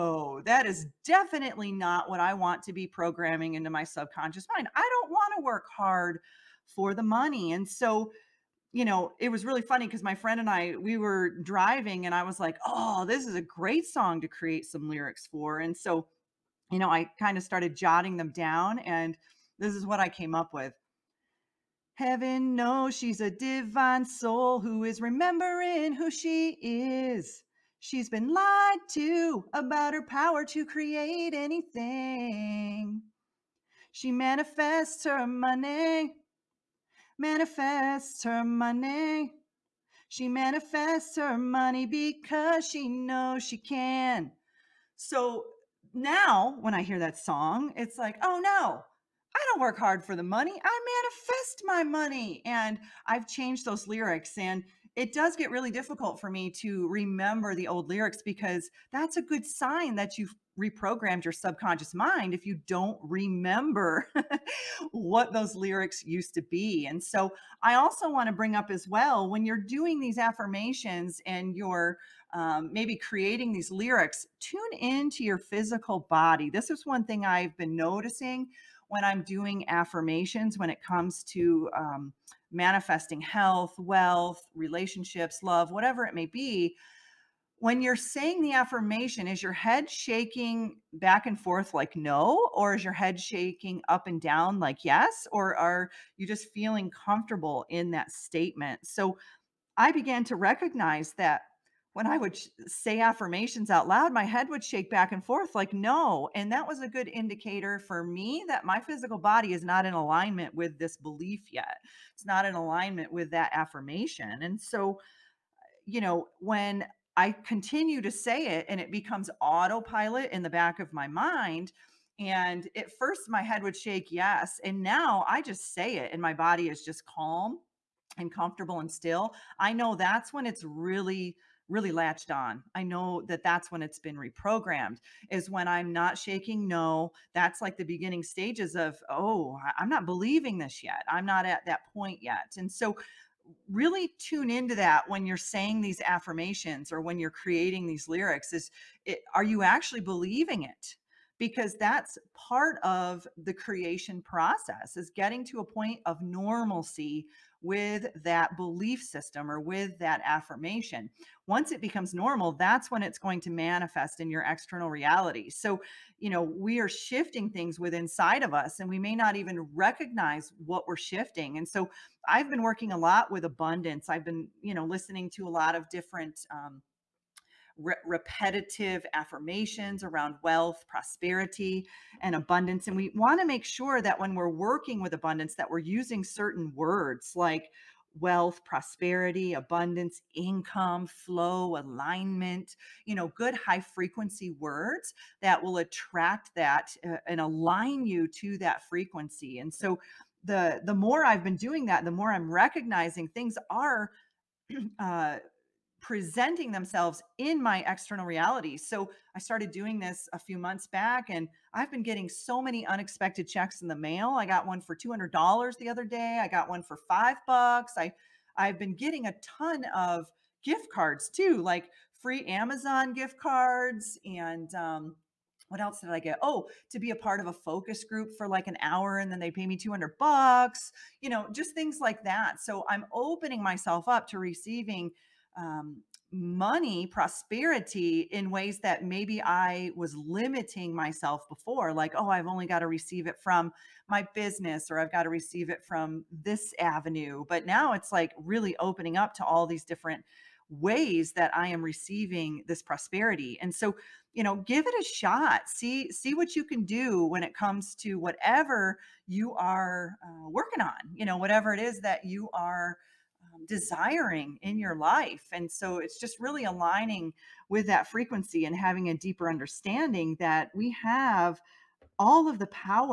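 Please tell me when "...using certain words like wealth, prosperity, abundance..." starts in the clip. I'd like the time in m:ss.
3:05.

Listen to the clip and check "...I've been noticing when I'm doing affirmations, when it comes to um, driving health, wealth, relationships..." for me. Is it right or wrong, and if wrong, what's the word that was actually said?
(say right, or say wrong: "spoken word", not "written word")
wrong: "manifesting", not "driving".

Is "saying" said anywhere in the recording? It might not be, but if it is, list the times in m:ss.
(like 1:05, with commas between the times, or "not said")
1:27, 2:25.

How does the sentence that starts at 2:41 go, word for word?
Once it becomes normal, that's when it's going to manifest in your external reality.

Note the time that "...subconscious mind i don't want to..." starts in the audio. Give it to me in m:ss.
0:03.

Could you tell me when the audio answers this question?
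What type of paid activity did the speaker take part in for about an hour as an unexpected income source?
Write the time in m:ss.
3:47.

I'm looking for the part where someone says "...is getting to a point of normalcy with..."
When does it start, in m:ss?
2:34.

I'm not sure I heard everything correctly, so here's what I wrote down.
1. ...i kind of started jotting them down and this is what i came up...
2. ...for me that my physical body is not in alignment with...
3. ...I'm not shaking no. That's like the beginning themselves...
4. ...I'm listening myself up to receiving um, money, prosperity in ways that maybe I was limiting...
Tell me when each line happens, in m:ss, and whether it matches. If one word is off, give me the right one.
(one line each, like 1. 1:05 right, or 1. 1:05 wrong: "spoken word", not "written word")
1. 0:16 right
2. 1:47 right
3. 2:15 wrong: "stages", not "themselves"
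4. 3:52 wrong: "opening", not "listening".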